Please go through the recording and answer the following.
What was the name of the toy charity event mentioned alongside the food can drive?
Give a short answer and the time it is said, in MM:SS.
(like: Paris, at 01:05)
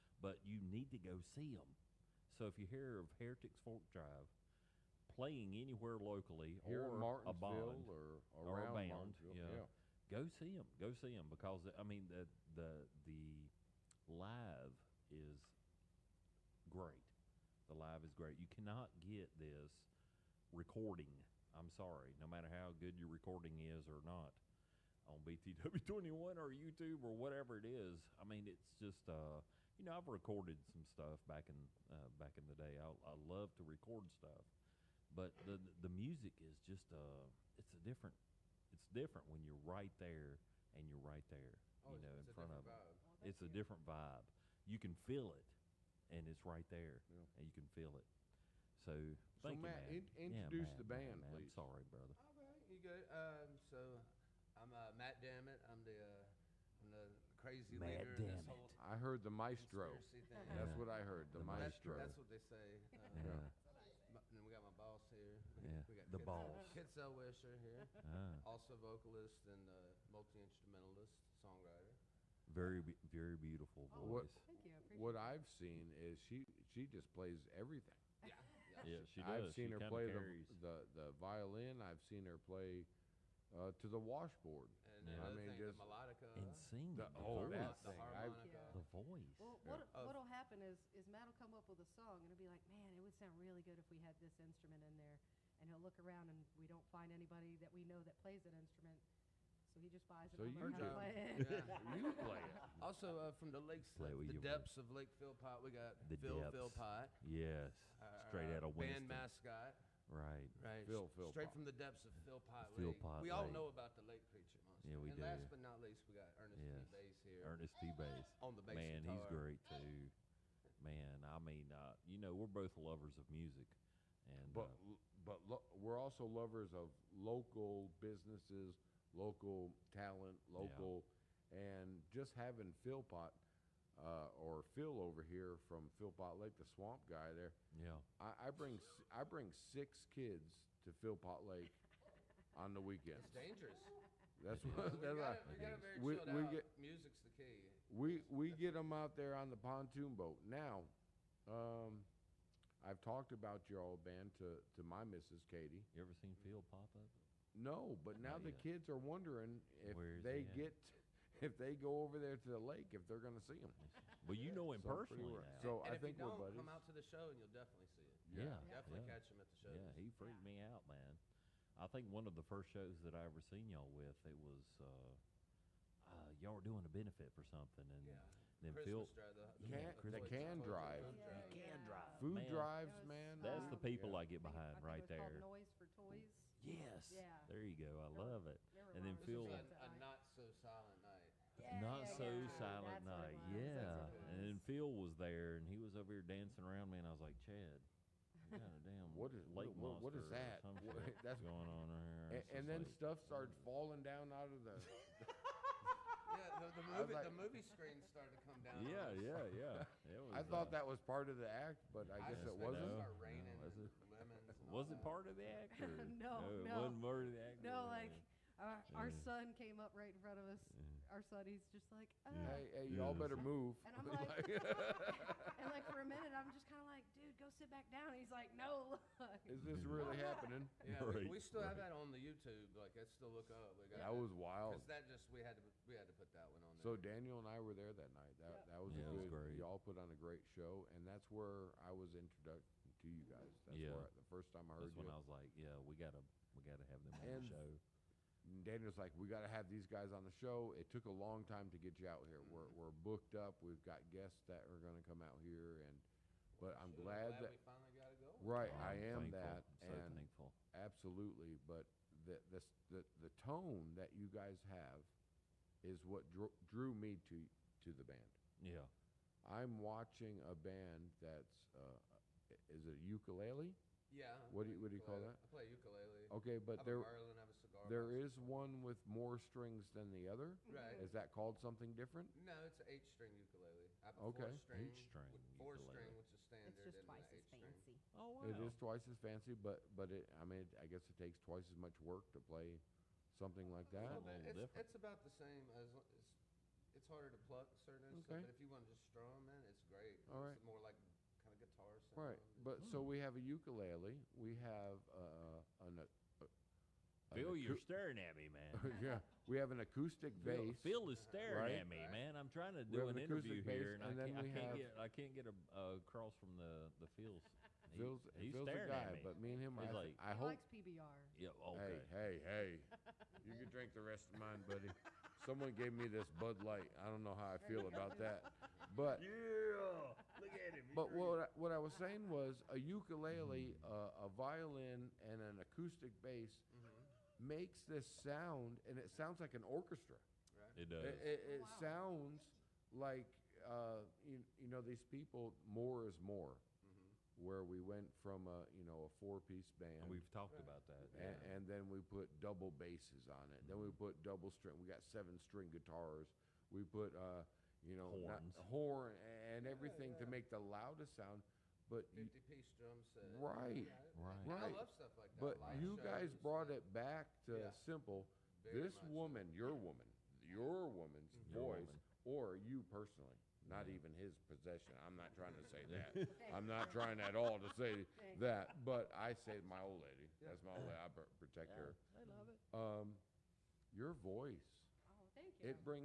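Noise for Toys, at 03:05.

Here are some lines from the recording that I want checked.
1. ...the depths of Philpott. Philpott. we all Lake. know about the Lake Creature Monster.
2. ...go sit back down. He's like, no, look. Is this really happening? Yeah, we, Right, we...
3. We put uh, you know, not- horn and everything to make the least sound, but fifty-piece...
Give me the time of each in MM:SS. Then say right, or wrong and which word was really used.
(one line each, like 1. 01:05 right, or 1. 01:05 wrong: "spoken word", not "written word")
1. 01:51 right
2. 03:47 right
3. 05:56 wrong: "loudest", not "least".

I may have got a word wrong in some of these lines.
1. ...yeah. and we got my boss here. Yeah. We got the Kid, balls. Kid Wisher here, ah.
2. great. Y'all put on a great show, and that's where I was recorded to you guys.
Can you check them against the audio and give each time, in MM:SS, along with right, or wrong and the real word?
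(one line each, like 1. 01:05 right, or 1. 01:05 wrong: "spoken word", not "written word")
1. 01:03 right
2. 03:59 wrong: "introduced", not "recorded".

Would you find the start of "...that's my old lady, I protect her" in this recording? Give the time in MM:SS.
06:20.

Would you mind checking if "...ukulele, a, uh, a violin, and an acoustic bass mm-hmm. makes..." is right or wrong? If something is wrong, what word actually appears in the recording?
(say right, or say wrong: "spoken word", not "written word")
right.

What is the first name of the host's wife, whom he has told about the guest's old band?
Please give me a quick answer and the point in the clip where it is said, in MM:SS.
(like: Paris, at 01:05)
Katie, at 02:35.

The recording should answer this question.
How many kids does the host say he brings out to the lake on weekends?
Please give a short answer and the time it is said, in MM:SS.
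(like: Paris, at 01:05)
6, at 02:19.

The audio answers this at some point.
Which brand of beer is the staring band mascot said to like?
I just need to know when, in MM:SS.
05:20.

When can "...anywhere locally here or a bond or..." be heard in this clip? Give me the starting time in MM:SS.
00:05.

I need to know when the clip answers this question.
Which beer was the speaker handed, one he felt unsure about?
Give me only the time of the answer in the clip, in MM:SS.
05:26.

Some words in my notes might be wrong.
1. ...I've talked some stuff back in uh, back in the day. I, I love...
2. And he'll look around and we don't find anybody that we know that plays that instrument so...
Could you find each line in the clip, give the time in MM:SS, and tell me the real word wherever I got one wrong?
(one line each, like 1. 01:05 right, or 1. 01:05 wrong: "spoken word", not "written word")
1. 00:29 wrong: "recorded", not "talked"
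2. 01:35 right.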